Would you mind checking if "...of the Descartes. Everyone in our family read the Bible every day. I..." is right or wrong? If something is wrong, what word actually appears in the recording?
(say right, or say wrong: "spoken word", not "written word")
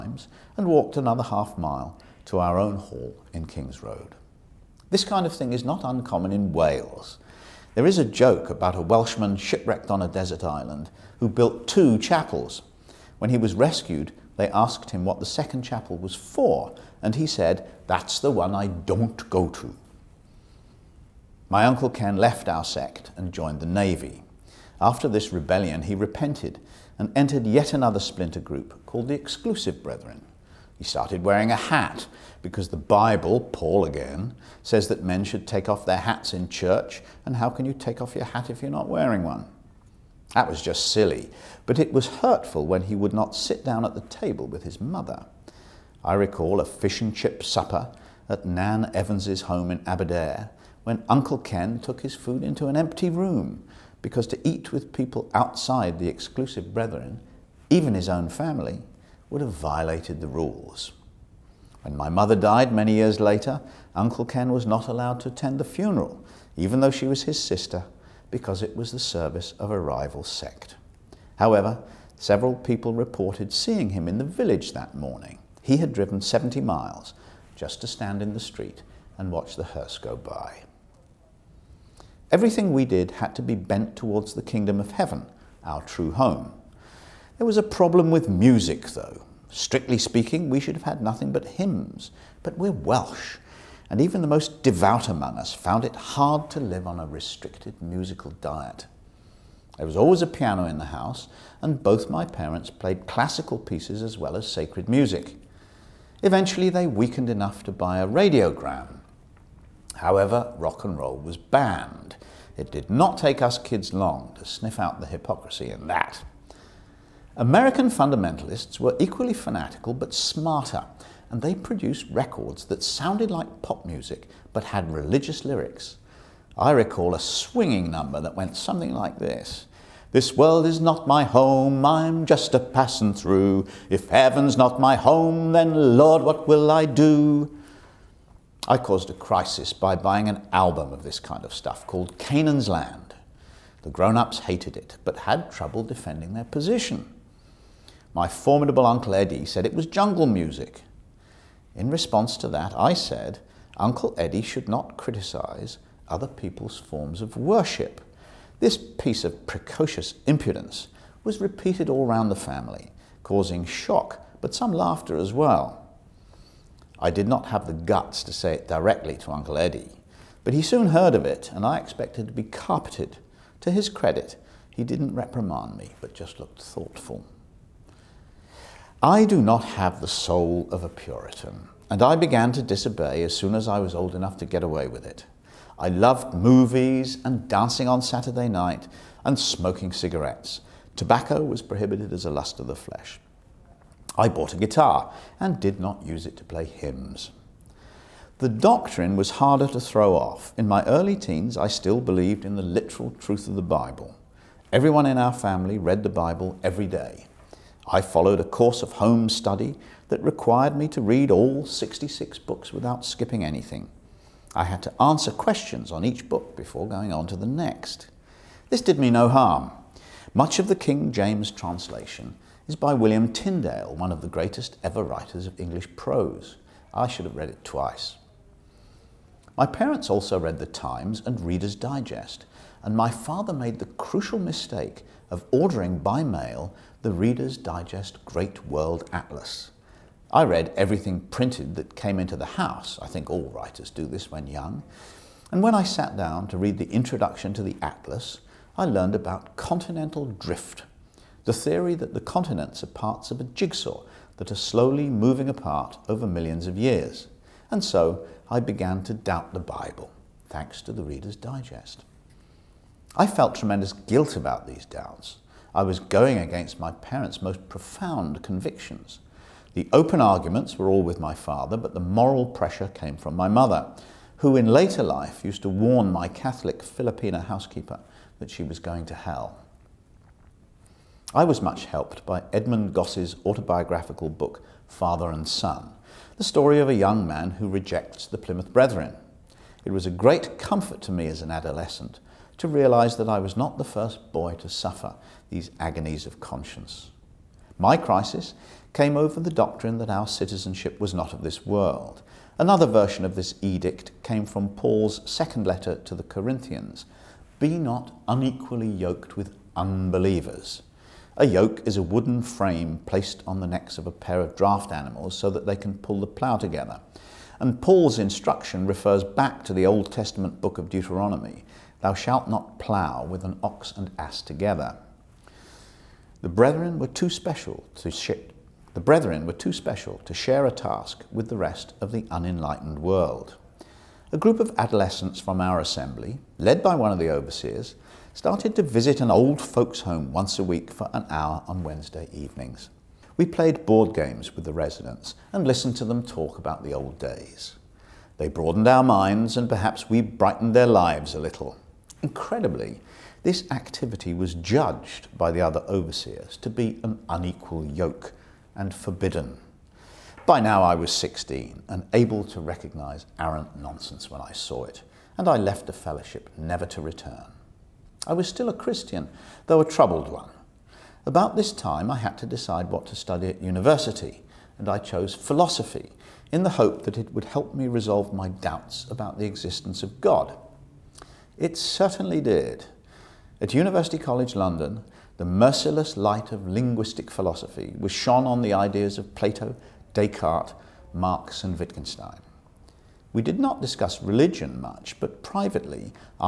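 wrong: "Bible", not "Descartes".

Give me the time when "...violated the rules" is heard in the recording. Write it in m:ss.
0:59.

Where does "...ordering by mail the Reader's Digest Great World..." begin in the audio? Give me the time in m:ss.
3:55.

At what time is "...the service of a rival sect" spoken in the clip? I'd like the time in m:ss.
1:08.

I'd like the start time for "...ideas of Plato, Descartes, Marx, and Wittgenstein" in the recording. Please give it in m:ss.
6:28.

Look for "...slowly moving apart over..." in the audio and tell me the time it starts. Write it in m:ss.
4:14.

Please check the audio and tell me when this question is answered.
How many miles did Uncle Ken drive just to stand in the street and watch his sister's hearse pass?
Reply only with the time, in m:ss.
1:16.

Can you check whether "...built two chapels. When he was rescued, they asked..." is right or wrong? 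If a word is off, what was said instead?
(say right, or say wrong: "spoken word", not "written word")
right.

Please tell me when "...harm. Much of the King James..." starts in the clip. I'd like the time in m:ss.
3:39.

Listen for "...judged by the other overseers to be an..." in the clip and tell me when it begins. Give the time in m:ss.
5:54.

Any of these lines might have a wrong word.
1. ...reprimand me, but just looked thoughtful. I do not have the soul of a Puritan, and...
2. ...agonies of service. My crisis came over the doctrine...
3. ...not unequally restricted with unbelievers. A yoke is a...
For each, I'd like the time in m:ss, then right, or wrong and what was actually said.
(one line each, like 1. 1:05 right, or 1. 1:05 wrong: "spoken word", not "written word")
1. 2:55 right
2. 4:55 wrong: "conscience", not "service"
3. 5:07 wrong: "yoked", not "restricted".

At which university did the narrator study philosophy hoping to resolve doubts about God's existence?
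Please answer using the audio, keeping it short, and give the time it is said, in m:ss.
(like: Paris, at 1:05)
University College London, at 6:23.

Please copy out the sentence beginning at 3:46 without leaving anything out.
I should have read it twice.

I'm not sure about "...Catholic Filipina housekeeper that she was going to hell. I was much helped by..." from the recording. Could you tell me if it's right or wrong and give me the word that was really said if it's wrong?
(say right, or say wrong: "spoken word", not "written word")
right.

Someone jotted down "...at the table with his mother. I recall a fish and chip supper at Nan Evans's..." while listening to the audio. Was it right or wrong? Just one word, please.
right.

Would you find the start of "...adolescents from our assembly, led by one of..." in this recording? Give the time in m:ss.
5:34.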